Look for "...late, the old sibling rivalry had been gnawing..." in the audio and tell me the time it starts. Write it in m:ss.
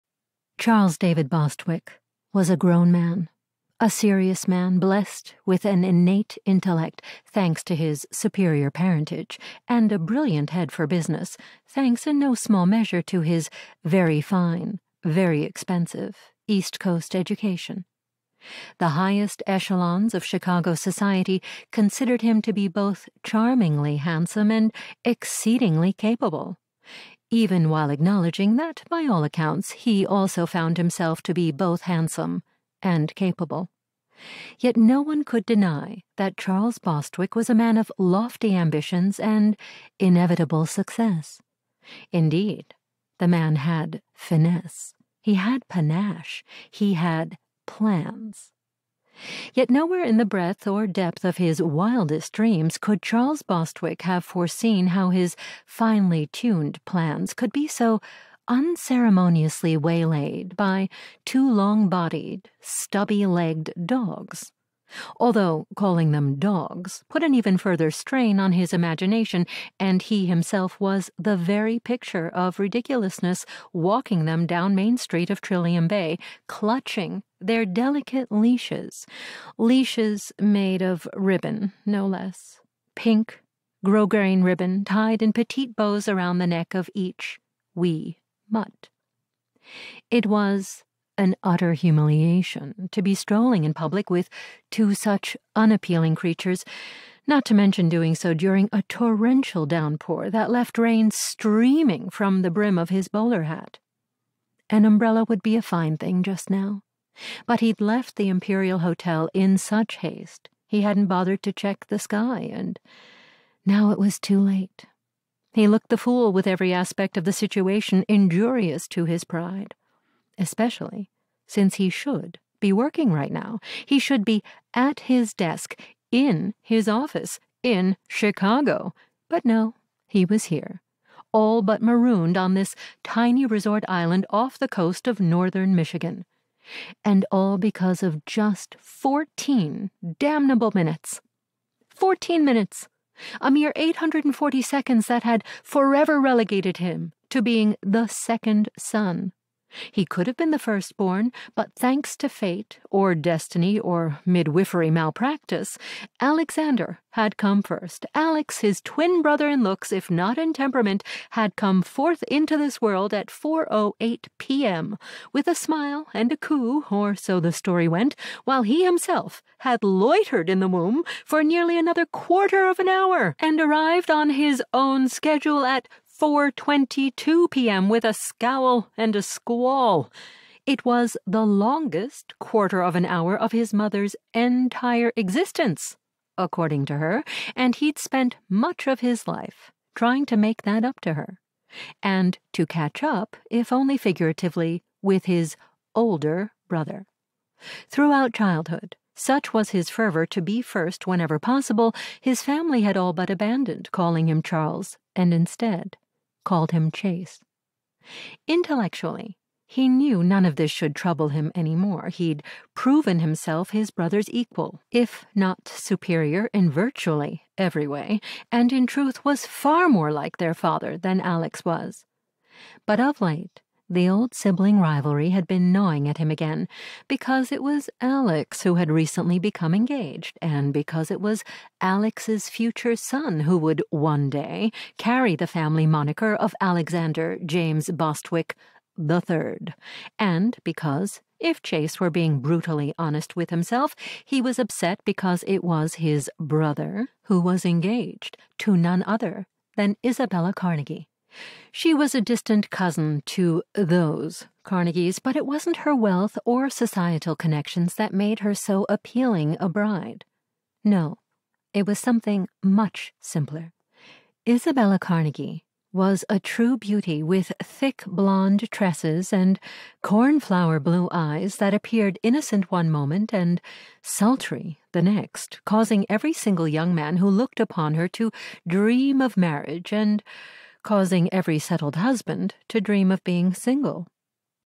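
3:43.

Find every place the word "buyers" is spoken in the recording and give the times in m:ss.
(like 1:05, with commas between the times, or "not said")
not said.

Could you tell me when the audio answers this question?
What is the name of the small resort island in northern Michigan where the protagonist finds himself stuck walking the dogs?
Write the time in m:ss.
1:15.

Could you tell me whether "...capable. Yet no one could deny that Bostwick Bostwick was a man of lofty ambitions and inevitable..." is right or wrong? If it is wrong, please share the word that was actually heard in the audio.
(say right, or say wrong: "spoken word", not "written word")
wrong: "Charles", not "Bostwick".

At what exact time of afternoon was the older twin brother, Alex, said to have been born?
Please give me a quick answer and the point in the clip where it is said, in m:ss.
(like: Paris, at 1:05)
4.08 p.m., at 2:43.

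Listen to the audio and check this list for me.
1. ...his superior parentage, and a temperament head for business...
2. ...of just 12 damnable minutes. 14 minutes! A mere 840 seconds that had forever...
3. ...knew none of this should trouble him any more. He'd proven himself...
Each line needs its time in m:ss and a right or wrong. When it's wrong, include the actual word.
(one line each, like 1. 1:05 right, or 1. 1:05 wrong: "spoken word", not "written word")
1. 0:07 wrong: "brilliant", not "temperament"
2. 2:18 wrong: "14", not "12"
3. 3:29 right.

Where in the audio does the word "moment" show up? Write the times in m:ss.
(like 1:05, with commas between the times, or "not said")
4:32.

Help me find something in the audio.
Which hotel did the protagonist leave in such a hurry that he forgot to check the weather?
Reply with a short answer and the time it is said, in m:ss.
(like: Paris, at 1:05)
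Imperial Hotel, at 1:48.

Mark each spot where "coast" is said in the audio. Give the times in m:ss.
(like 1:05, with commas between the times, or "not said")
0:16, 2:14.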